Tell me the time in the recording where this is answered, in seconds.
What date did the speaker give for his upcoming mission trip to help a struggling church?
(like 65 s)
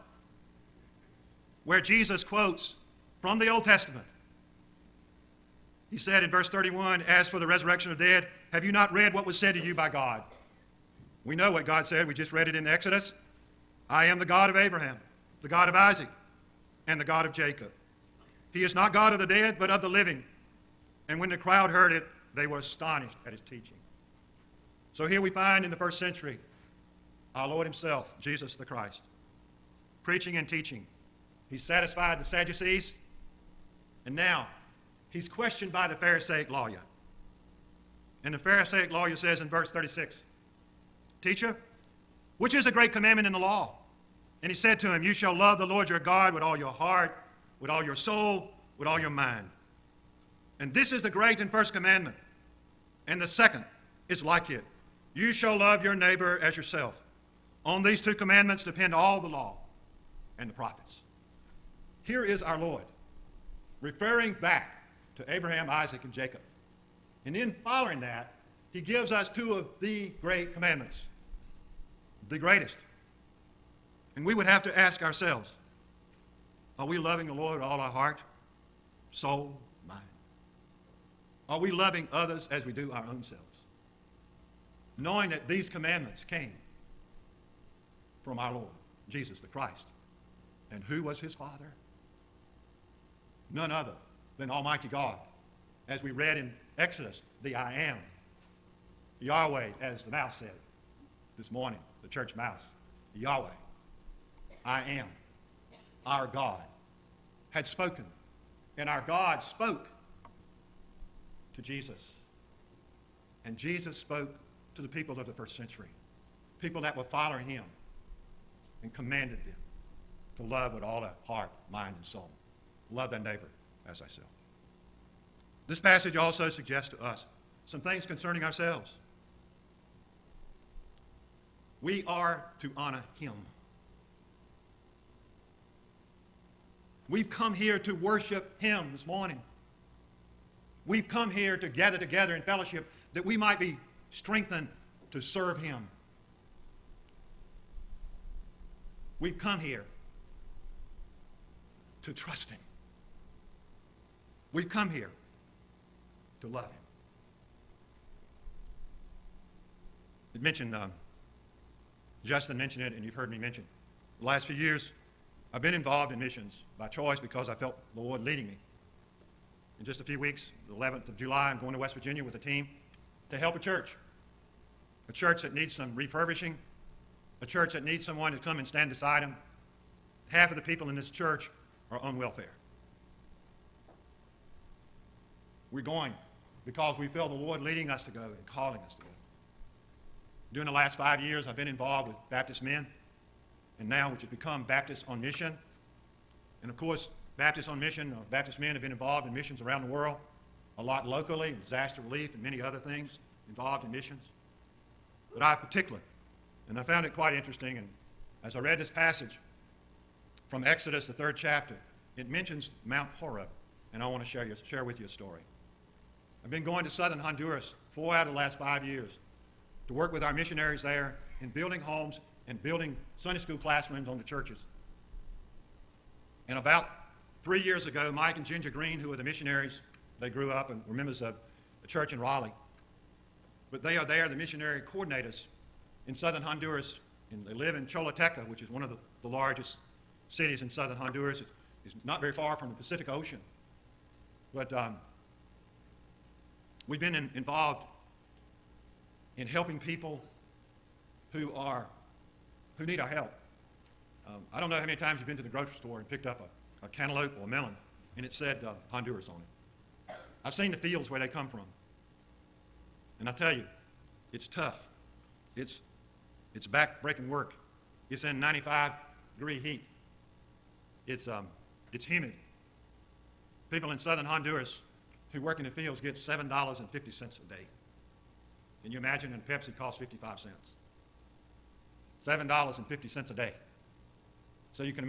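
170 s.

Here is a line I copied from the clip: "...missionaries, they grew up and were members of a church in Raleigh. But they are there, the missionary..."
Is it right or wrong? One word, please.
right.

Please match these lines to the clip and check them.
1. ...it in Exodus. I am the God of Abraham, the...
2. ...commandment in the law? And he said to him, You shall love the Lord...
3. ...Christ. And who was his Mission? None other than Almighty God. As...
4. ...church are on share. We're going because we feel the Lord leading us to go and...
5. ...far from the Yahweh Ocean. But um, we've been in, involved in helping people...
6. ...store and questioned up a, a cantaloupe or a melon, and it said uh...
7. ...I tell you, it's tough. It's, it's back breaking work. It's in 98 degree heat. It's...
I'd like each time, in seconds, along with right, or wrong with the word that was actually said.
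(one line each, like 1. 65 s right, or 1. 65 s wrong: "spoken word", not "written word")
1. 12 s right
2. 42 s right
3. 89 s wrong: "Father", not "Mission"
4. 181 s wrong: "welfare", not "share"
5. 242 s wrong: "Pacific", not "Yahweh"
6. 255 s wrong: "picked", not "questioned"
7. 263 s wrong: "95", not "98".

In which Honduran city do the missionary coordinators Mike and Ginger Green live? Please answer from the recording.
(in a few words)
Choluteca.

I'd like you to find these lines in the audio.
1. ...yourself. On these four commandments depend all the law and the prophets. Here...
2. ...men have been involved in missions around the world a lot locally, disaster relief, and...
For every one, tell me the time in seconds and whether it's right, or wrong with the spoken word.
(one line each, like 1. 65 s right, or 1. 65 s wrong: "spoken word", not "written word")
1. 56 s wrong: "two", not "four"
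2. 198 s right.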